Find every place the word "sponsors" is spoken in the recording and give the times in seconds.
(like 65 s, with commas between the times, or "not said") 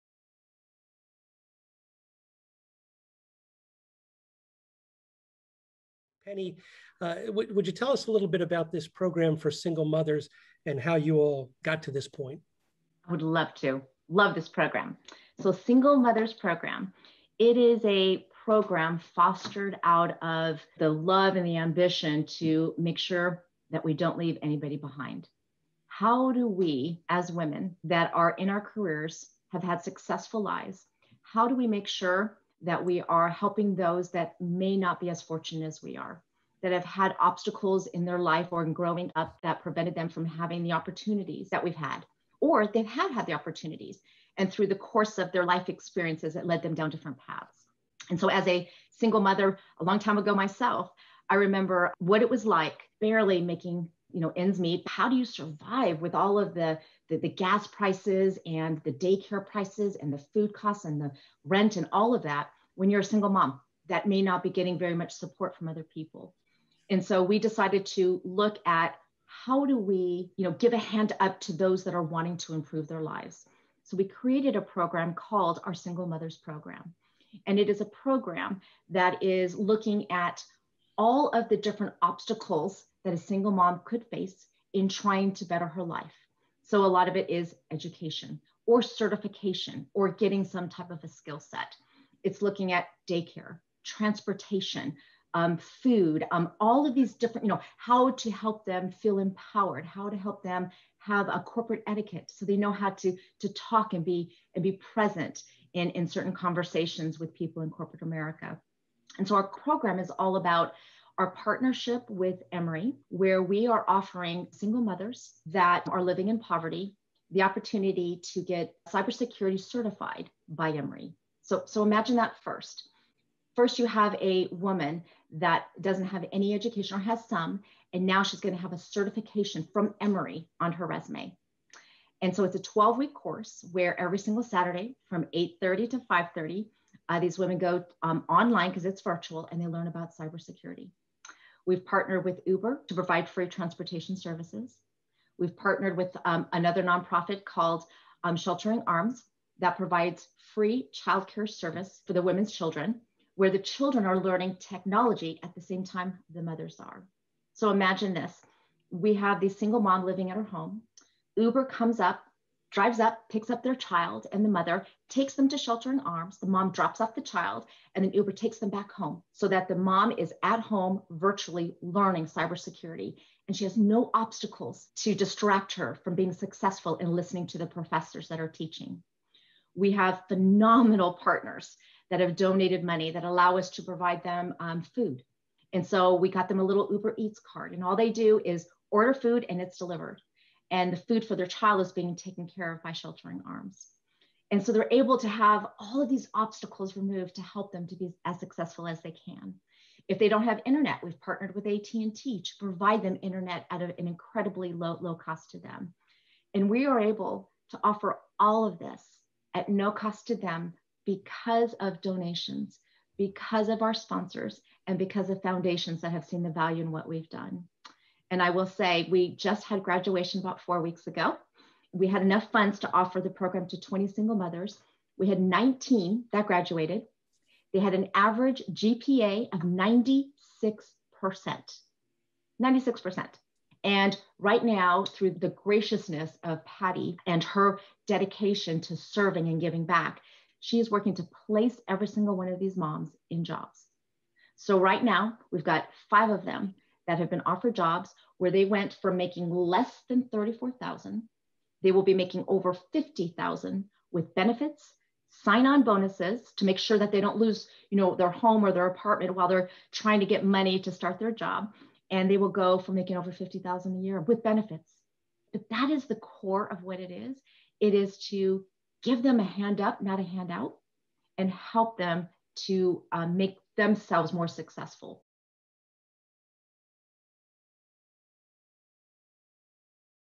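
213 s.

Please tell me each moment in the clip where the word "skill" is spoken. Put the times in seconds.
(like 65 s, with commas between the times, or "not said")
91 s.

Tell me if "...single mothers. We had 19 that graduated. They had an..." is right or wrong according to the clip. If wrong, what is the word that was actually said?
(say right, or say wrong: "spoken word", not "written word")
right.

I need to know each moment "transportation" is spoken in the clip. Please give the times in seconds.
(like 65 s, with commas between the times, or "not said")
93 s, 143 s.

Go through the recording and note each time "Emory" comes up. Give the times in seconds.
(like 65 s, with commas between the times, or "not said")
112 s, 120 s, 130 s.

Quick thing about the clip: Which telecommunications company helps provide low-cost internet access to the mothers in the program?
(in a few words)
AT&T.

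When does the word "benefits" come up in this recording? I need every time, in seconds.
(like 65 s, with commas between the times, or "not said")
254 s, 264 s.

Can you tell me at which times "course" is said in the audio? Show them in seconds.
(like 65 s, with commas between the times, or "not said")
44 s, 133 s.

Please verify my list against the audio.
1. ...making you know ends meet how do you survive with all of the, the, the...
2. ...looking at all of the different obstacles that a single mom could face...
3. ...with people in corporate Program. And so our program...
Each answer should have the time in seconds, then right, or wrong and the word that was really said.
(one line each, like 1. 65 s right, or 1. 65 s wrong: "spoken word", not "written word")
1. 53 s right
2. 79 s right
3. 107 s wrong: "America", not "Program".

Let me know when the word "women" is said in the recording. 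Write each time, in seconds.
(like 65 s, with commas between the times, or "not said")
27 s, 137 s, 152 s.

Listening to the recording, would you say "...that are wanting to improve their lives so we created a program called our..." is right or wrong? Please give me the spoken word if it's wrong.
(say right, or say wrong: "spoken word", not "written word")
right.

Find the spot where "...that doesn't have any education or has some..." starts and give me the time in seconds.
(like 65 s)
125 s.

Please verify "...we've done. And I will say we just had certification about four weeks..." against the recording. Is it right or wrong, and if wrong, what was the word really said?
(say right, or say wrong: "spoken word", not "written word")
wrong: "graduation", not "certification".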